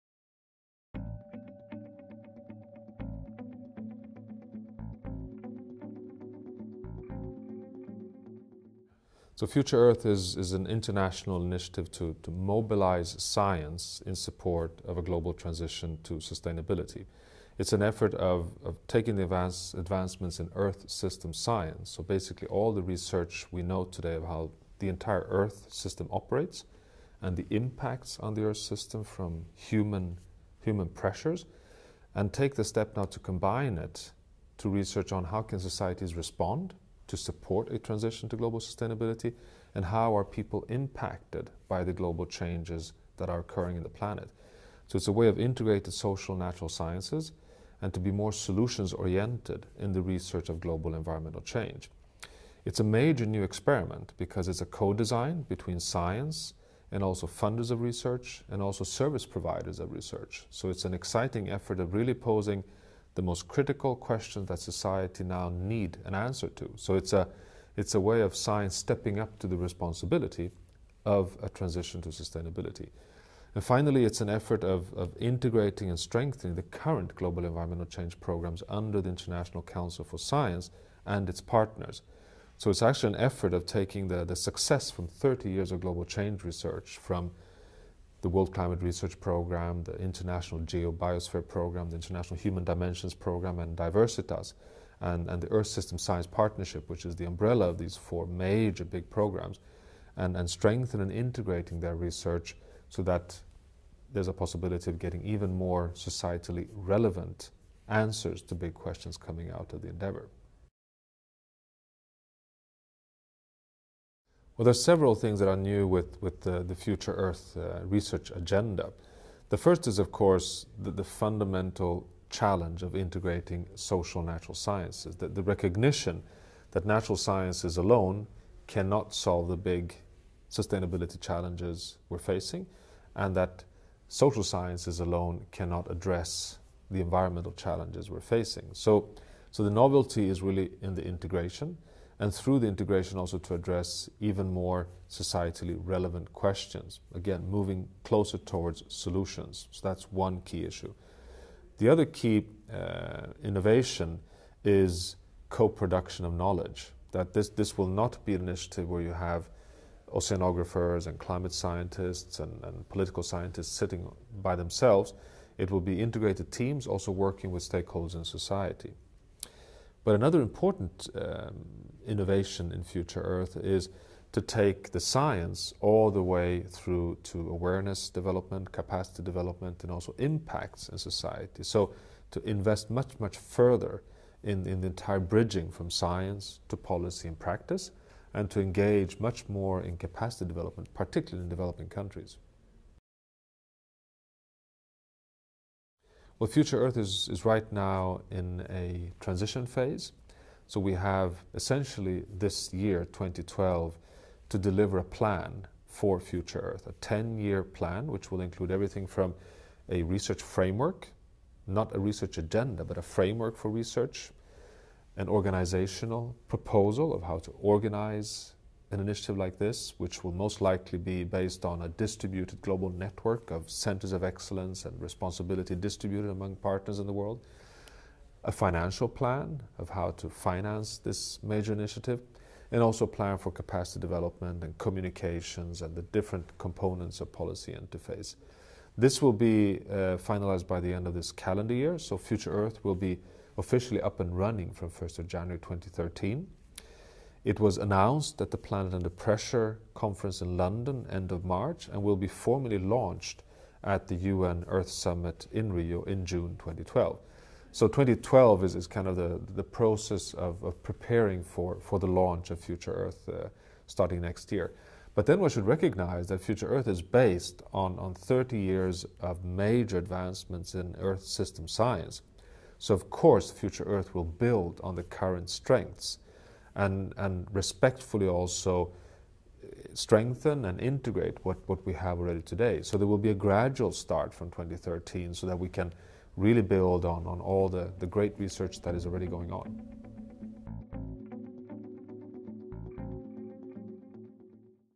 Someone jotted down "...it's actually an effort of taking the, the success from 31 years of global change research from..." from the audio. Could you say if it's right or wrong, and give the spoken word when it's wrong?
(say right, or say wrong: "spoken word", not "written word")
wrong: "30", not "31".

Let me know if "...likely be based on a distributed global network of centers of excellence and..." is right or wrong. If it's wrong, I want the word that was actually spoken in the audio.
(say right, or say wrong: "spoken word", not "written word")
right.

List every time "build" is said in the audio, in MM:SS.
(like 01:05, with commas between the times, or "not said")
04:34, 04:46.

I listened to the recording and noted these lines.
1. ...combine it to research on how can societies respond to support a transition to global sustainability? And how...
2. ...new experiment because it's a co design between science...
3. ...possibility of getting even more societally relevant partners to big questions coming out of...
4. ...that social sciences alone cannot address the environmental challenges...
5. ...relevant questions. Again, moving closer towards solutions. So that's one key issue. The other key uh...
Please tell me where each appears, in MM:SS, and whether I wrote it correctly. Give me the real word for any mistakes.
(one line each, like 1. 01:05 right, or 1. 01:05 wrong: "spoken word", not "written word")
1. 00:33 right
2. 00:53 right
3. 01:44 wrong: "answers", not "partners"
4. 02:13 right
5. 02:25 right.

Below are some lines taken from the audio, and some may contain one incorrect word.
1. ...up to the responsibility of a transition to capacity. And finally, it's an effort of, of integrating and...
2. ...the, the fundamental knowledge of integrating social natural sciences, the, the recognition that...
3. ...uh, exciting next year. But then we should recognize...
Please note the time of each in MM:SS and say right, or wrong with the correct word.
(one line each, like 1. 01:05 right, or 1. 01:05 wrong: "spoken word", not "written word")
1. 01:09 wrong: "sustainability", not "capacity"
2. 02:00 wrong: "challenge", not "knowledge"
3. 04:23 wrong: "starting", not "exciting".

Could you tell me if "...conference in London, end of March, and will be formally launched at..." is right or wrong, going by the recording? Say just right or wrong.
right.